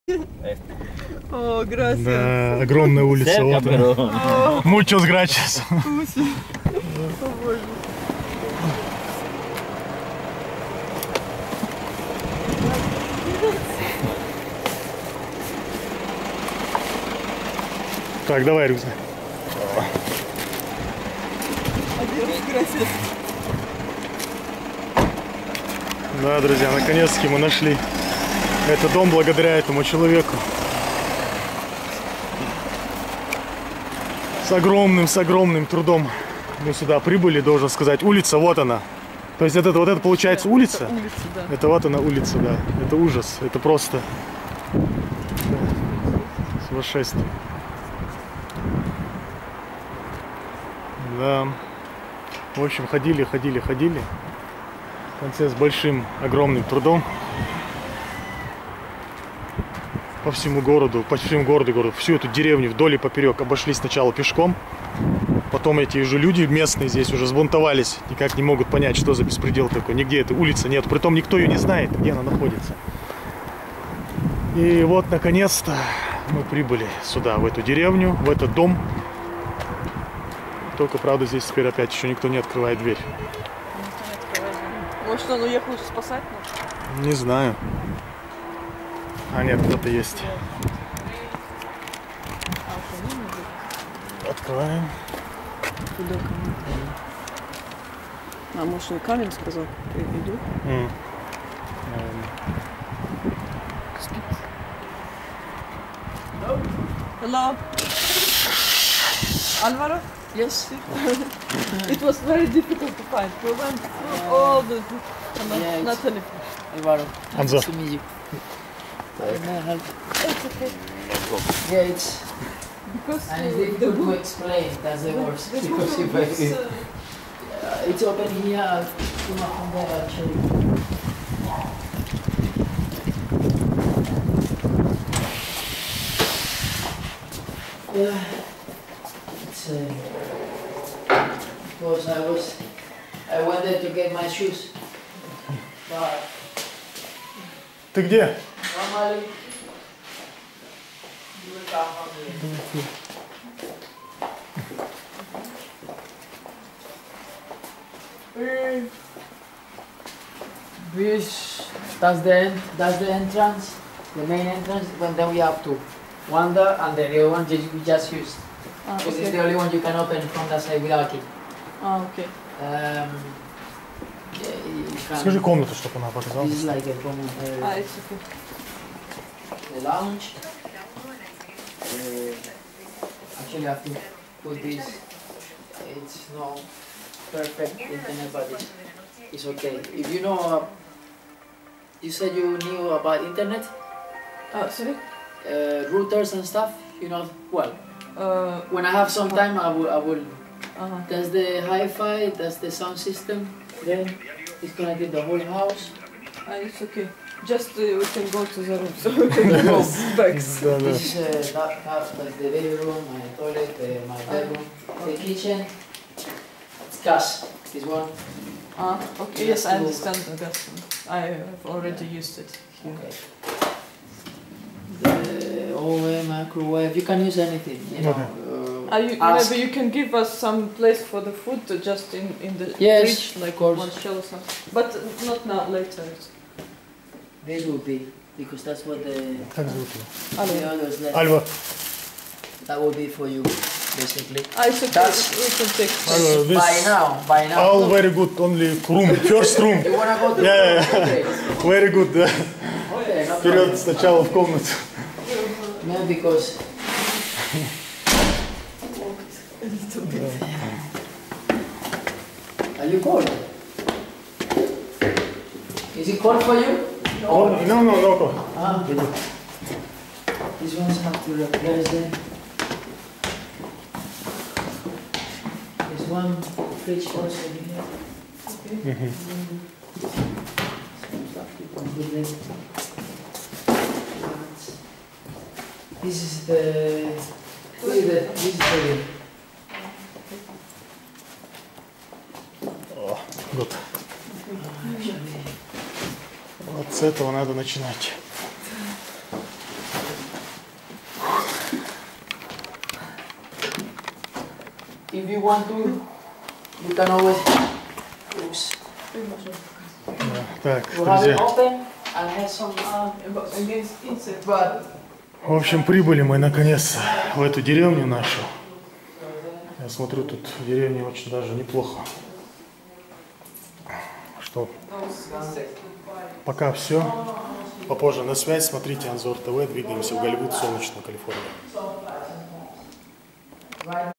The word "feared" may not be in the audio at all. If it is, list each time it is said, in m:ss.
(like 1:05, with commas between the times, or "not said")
not said.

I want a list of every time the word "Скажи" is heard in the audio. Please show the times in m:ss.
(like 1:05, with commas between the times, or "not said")
2:55.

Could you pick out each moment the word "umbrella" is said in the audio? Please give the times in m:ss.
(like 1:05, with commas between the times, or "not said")
not said.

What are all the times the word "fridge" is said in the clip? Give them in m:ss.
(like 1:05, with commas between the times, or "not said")
3:53, 4:36.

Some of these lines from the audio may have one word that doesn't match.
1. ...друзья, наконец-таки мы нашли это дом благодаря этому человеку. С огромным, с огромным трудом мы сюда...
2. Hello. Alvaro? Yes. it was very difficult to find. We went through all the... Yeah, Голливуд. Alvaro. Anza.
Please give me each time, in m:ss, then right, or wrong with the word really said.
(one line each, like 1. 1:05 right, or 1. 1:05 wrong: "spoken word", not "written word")
1. 0:26 right
2. 1:47 wrong: "Natalie", not "Голливуд".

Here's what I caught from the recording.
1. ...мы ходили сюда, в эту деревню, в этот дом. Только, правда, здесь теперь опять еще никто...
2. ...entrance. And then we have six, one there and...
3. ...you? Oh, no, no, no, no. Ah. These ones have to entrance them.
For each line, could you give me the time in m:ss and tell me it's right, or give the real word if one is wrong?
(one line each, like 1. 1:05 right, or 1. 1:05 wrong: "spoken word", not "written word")
1. 1:16 wrong: "прибыли", not "ходили"
2. 2:44 wrong: "two", not "six"
3. 4:26 wrong: "replace", not "entrance".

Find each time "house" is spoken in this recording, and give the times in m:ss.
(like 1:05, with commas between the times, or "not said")
3:25.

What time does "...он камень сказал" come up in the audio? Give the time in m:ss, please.
1:38.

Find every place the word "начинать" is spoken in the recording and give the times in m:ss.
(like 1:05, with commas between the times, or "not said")
4:57.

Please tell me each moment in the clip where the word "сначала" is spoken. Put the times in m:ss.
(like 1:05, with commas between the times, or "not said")
1:03, 4:13.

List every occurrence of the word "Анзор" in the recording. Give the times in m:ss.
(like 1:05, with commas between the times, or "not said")
5:29.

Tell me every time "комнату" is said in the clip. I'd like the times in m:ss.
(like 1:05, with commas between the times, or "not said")
2:55, 4:14.